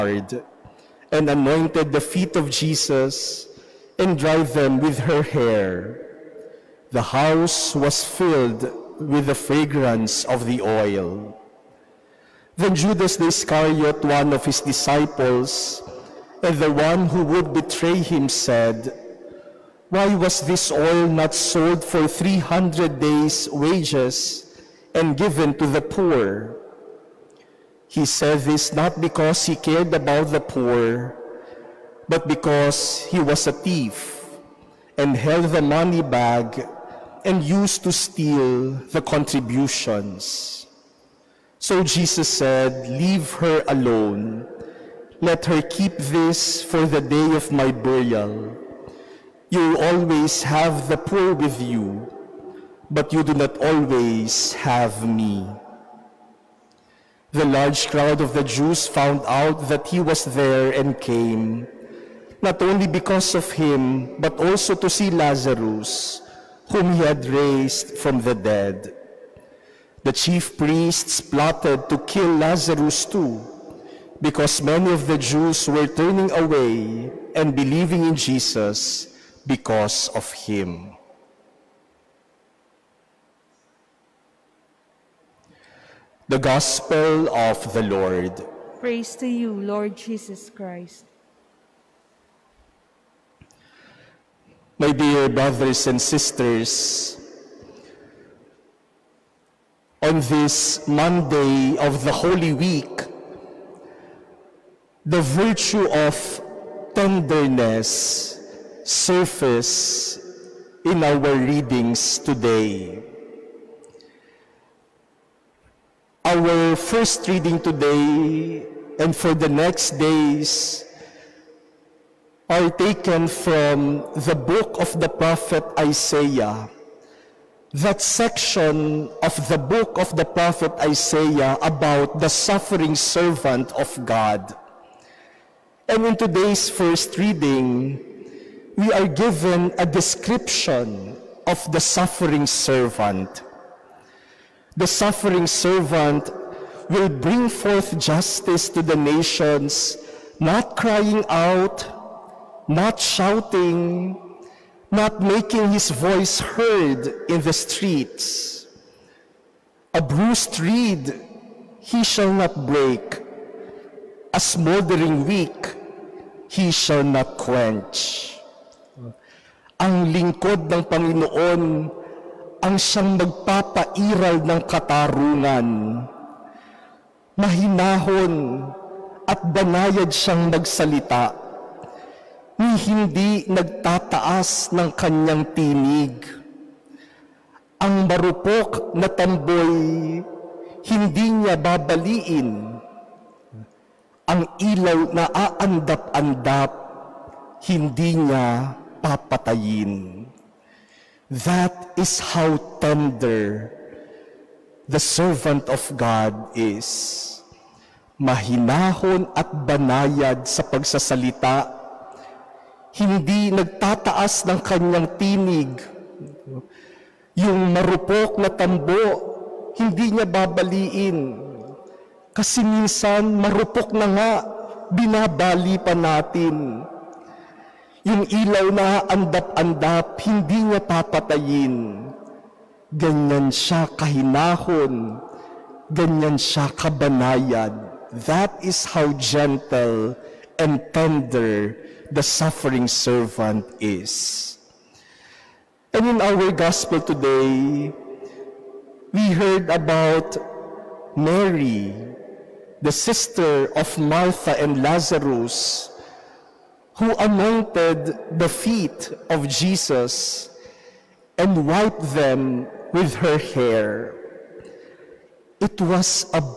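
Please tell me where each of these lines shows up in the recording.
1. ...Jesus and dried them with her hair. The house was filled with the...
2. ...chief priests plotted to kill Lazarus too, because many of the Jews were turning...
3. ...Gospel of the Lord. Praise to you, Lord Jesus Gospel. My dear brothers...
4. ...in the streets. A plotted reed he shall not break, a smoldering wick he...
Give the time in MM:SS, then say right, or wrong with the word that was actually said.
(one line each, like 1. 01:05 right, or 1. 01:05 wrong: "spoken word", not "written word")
1. 00:02 right
2. 01:10 right
3. 01:26 wrong: "Christ", not "Gospel"
4. 02:37 wrong: "bruised", not "plotted".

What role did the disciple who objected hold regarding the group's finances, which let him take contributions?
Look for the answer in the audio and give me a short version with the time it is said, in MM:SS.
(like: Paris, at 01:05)
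held the money bag, at 00:35.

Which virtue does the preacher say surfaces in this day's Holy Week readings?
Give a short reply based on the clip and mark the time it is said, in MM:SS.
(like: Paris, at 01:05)
tenderness, at 01:46.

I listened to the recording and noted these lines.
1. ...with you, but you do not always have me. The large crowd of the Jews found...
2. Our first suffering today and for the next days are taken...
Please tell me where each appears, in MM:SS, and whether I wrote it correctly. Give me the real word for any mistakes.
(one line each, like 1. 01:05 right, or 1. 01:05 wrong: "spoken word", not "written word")
1. 00:51 right
2. 01:56 wrong: "reading", not "suffering".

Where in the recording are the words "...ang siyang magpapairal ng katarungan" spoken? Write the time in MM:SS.
02:52.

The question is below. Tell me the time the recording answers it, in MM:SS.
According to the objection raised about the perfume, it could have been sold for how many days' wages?
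00:22.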